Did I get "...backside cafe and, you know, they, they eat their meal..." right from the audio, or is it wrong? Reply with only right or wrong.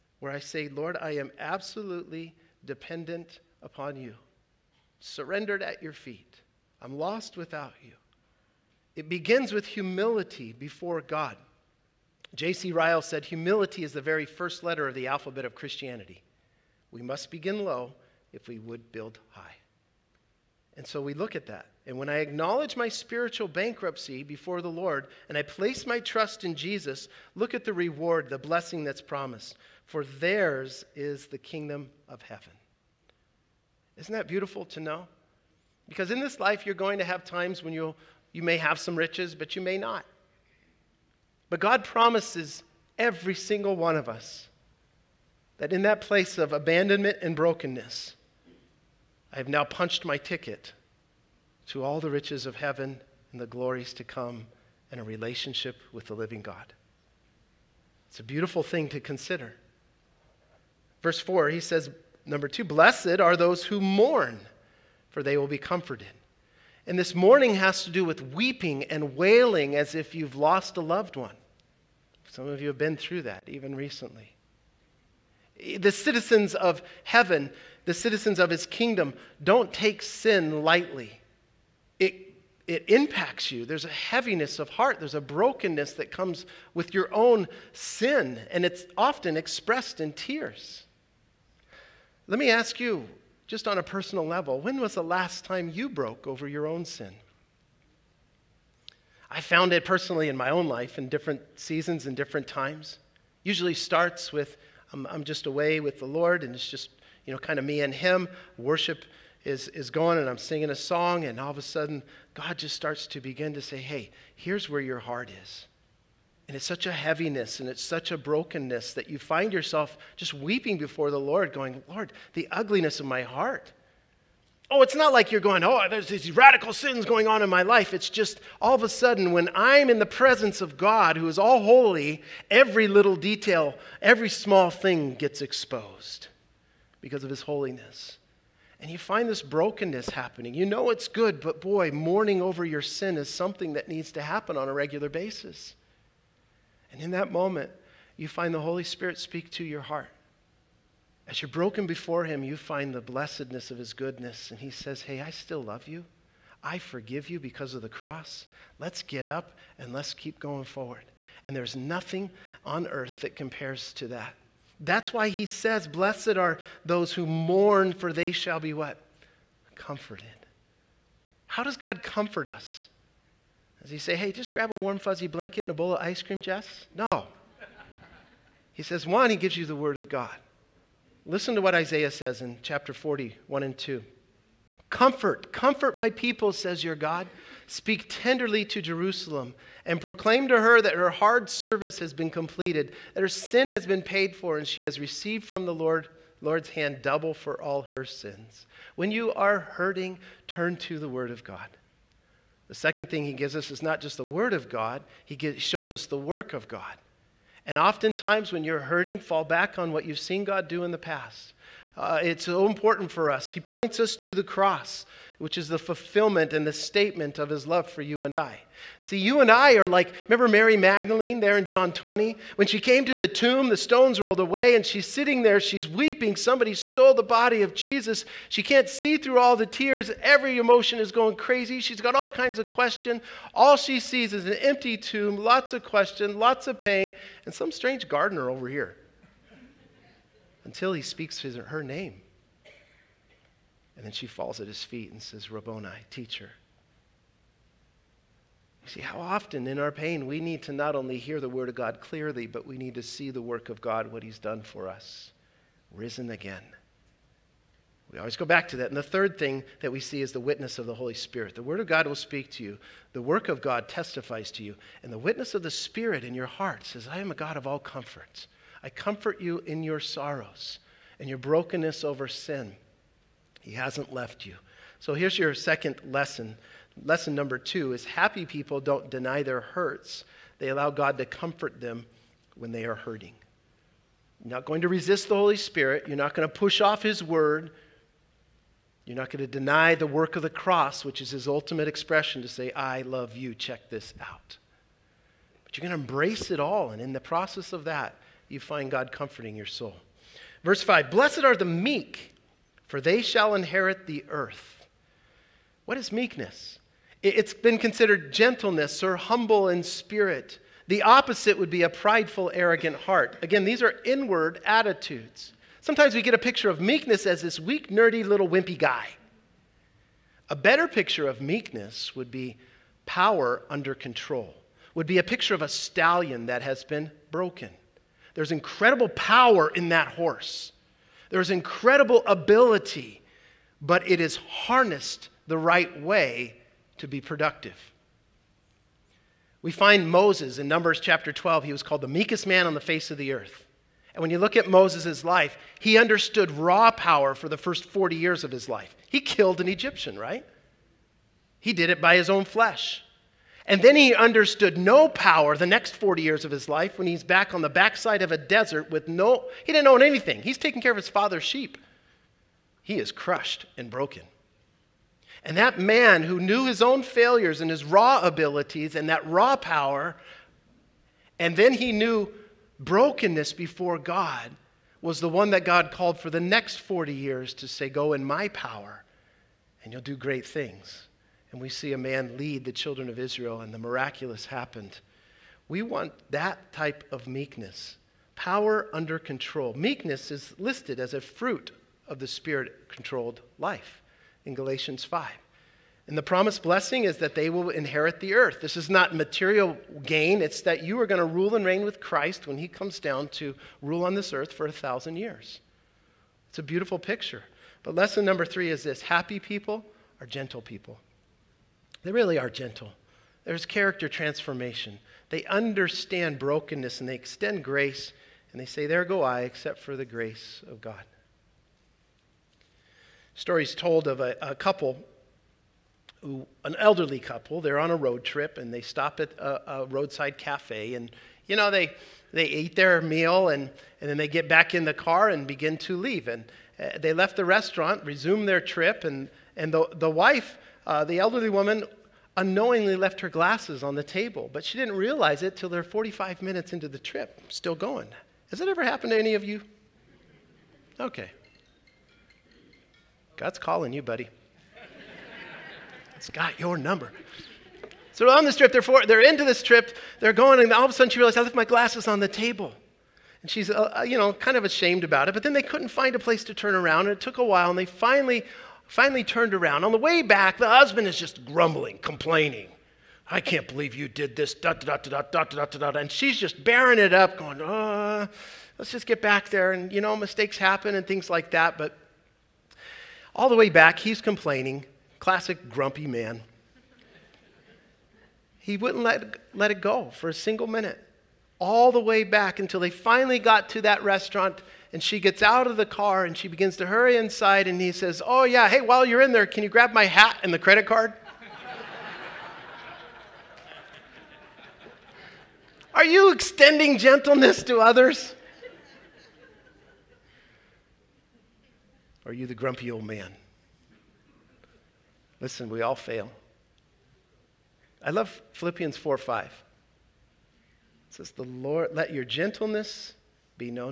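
wrong.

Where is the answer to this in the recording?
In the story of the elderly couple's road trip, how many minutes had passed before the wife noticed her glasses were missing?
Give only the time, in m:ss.
7:25.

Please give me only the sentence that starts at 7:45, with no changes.
But then they couldn't find a place to turn around, and it took a while, and they finally finally turned around.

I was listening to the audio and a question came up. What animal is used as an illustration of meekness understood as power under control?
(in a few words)
A stallion.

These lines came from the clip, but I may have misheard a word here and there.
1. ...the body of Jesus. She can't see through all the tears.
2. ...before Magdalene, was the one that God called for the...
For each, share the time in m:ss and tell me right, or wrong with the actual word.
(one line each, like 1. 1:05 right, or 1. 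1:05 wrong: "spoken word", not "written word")
1. 3:47 right
2. 6:13 wrong: "God", not "Magdalene".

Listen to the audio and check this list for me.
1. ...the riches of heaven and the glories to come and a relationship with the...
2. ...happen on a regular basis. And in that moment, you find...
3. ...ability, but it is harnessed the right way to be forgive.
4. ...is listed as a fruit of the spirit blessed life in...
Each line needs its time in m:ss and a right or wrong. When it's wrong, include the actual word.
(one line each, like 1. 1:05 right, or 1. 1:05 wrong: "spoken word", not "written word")
1. 0:51 right
2. 2:24 right
3. 5:32 wrong: "productive", not "forgive"
4. 6:30 wrong: "controlled", not "blessed".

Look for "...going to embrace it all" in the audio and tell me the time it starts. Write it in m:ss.
4:55.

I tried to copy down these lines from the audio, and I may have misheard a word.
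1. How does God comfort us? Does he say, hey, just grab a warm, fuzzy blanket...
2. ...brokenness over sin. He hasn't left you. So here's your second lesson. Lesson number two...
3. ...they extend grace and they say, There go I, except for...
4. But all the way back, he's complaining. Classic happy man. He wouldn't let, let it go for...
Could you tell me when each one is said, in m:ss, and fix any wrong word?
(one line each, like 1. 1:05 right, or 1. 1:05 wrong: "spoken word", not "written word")
1. 2:51 right
2. 4:31 right
3. 6:57 right
4. 8:01 wrong: "grumpy", not "happy".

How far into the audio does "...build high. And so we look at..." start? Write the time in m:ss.
0:18.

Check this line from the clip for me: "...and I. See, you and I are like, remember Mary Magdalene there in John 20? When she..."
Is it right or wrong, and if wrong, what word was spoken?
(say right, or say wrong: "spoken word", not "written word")
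right.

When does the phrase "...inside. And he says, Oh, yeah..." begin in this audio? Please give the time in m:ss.
8:17.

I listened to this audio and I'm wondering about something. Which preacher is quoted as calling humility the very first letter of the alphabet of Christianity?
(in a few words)
J.C. Ryle.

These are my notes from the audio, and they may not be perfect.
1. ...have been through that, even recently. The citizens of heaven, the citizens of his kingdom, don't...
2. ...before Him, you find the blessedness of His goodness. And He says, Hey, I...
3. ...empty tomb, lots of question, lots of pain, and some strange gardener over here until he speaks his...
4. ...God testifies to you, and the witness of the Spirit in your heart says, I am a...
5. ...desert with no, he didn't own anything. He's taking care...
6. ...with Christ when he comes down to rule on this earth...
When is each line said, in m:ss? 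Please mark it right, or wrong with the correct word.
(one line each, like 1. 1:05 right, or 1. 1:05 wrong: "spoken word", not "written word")
1. 1:12 right
2. 2:31 right
3. 3:54 right
4. 4:23 right
5. 5:58 right
6. 6:41 right.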